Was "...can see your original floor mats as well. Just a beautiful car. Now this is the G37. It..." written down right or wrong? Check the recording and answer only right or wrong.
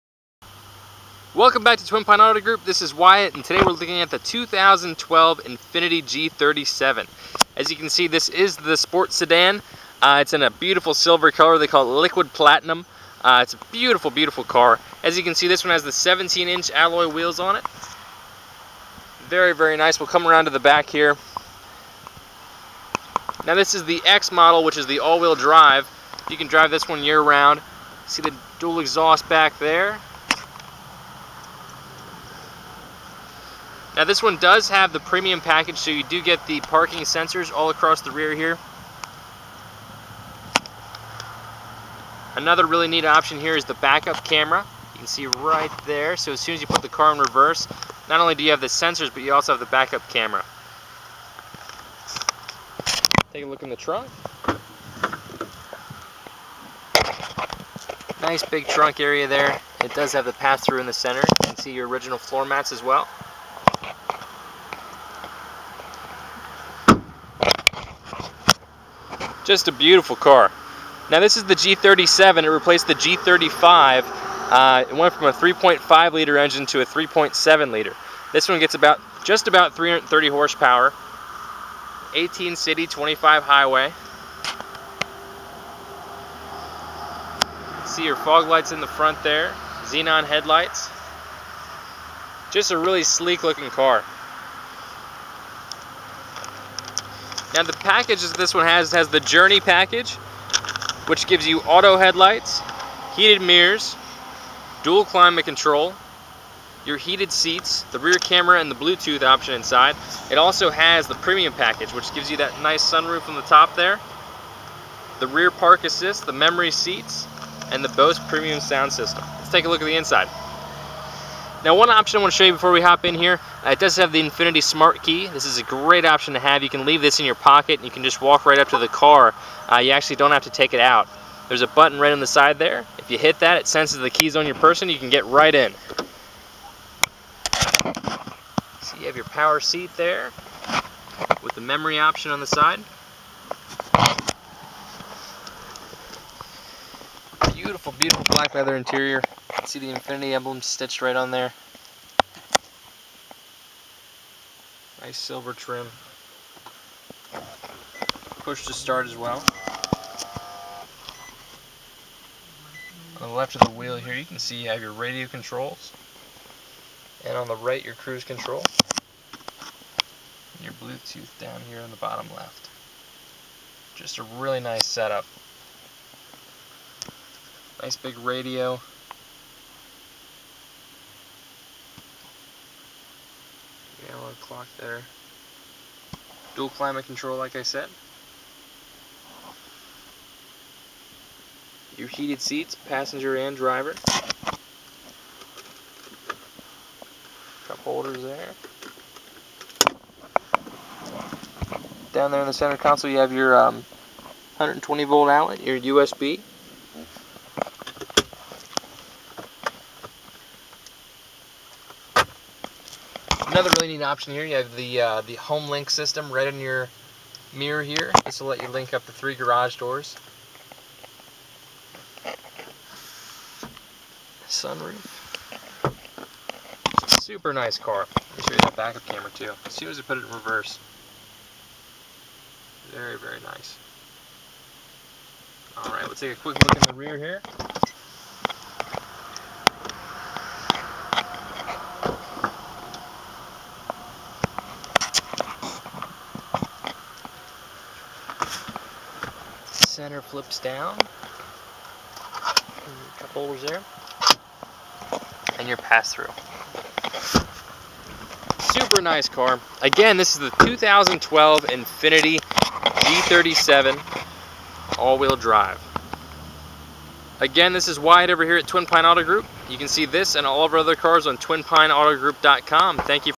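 right.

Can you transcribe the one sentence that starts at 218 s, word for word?
This will let you link up the three garage doors.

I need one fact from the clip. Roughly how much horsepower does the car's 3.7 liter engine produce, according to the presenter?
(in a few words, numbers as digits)
330.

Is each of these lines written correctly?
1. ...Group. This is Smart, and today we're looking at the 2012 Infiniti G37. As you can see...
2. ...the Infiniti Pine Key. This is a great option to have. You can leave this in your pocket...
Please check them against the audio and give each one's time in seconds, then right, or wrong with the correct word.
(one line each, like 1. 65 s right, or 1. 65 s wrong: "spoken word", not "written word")
1. 2 s wrong: "Wyatt", not "Smart"
2. 124 s wrong: "Smart", not "Pine".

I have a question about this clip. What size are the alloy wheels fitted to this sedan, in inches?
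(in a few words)
17.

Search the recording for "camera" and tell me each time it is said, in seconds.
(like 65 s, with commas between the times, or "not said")
44 s, 50 s, 108 s, 229 s.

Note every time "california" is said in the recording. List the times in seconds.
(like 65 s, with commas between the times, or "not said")
not said.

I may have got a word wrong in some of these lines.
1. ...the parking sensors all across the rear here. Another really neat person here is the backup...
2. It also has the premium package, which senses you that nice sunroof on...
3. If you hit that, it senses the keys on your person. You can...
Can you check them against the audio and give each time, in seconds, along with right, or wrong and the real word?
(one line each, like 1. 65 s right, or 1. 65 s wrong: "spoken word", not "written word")
1. 36 s wrong: "option", not "person"
2. 110 s wrong: "gives", not "senses"
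3. 132 s right.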